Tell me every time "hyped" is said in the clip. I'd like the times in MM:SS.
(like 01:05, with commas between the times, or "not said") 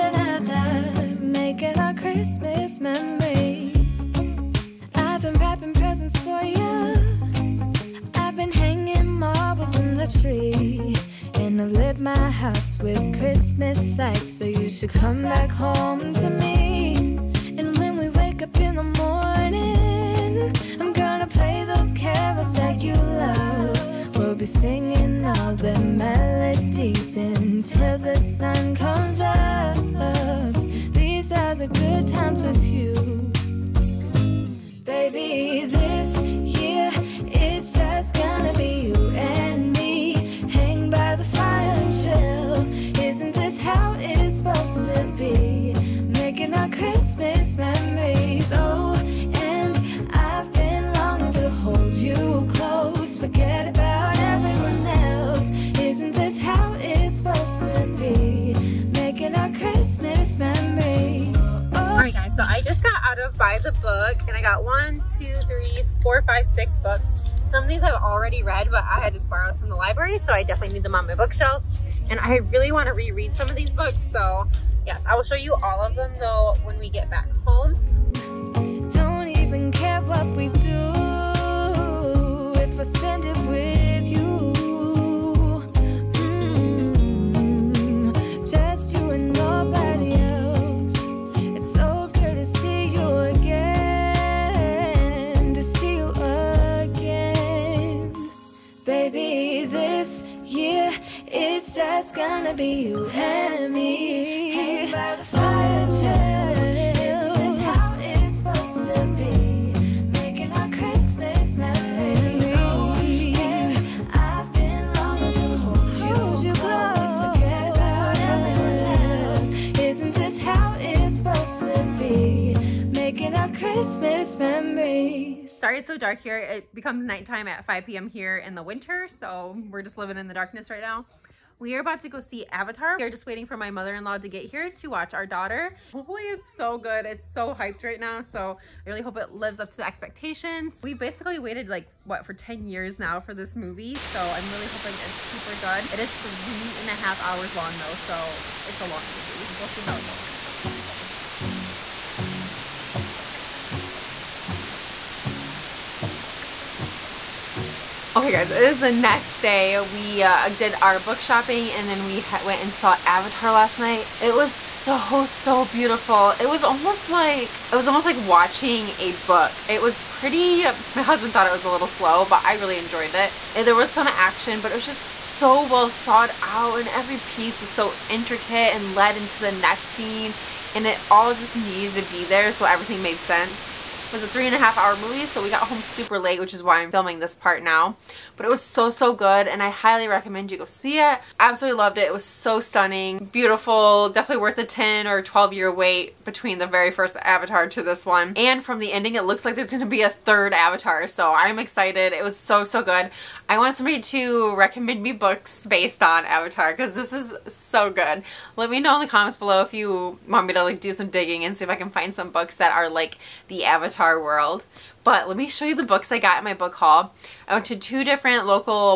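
02:17.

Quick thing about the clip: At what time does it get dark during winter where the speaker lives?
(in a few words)
5 p.m.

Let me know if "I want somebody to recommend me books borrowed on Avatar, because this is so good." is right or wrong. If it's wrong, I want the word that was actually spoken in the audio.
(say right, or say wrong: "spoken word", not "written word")
wrong: "based", not "borrowed".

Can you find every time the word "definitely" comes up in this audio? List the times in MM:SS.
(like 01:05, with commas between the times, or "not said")
01:10, 03:14.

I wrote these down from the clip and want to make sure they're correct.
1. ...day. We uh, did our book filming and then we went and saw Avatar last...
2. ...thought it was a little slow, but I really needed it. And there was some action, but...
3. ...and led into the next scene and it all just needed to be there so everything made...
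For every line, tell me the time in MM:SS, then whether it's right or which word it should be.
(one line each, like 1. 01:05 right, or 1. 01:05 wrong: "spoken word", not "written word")
1. 02:39 wrong: "shopping", not "filming"
2. 02:51 wrong: "enjoyed", not "needed"
3. 02:58 right.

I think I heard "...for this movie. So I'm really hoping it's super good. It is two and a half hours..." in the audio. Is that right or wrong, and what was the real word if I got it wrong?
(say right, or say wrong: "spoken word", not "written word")
wrong: "three", not "two".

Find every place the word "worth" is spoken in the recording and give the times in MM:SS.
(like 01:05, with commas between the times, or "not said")
03:14.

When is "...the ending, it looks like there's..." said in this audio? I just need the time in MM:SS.
03:18.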